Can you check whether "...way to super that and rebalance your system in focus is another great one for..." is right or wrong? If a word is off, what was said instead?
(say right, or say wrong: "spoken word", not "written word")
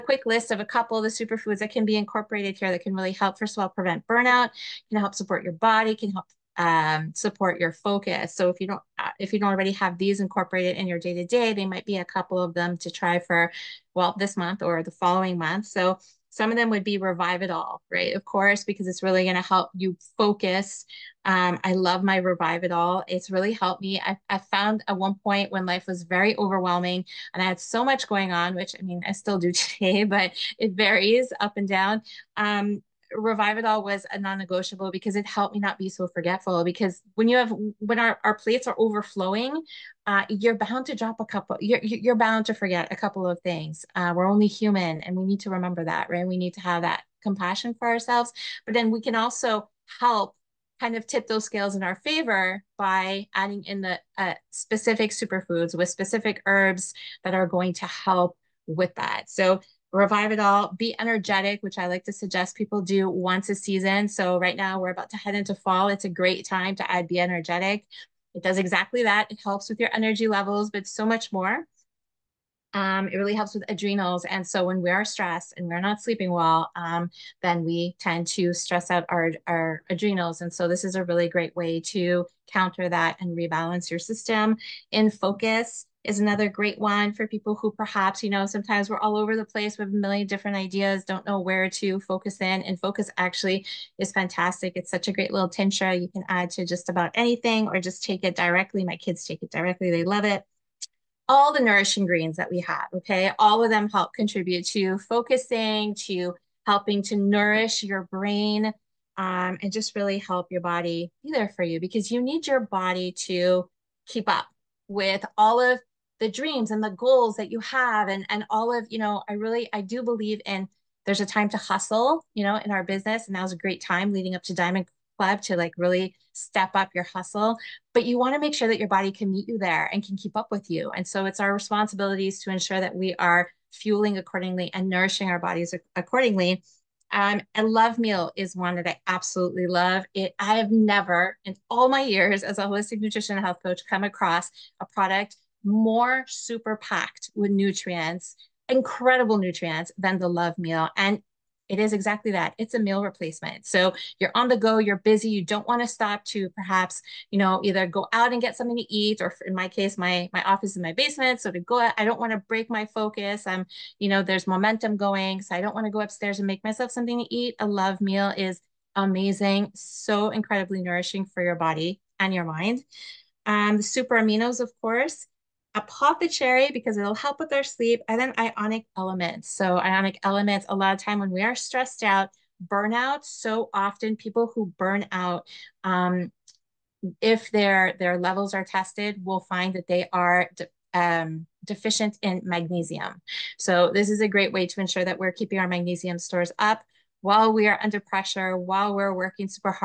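wrong: "counter", not "super".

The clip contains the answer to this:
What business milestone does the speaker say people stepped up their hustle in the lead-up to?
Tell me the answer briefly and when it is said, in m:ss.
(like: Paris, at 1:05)
Diamond Club, at 2:04.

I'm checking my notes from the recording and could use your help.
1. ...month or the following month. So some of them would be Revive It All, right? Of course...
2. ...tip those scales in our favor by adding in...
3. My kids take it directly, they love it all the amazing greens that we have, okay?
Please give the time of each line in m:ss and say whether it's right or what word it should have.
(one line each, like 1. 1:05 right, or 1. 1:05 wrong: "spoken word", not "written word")
1. 0:14 right
2. 0:51 right
3. 1:38 wrong: "nourishing", not "amazing".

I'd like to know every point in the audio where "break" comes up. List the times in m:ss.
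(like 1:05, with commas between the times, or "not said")
2:42.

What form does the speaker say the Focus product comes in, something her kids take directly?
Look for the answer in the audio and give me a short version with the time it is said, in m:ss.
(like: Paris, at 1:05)
tincture, at 1:35.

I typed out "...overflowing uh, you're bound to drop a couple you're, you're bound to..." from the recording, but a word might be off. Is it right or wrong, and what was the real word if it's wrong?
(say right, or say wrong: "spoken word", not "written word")
right.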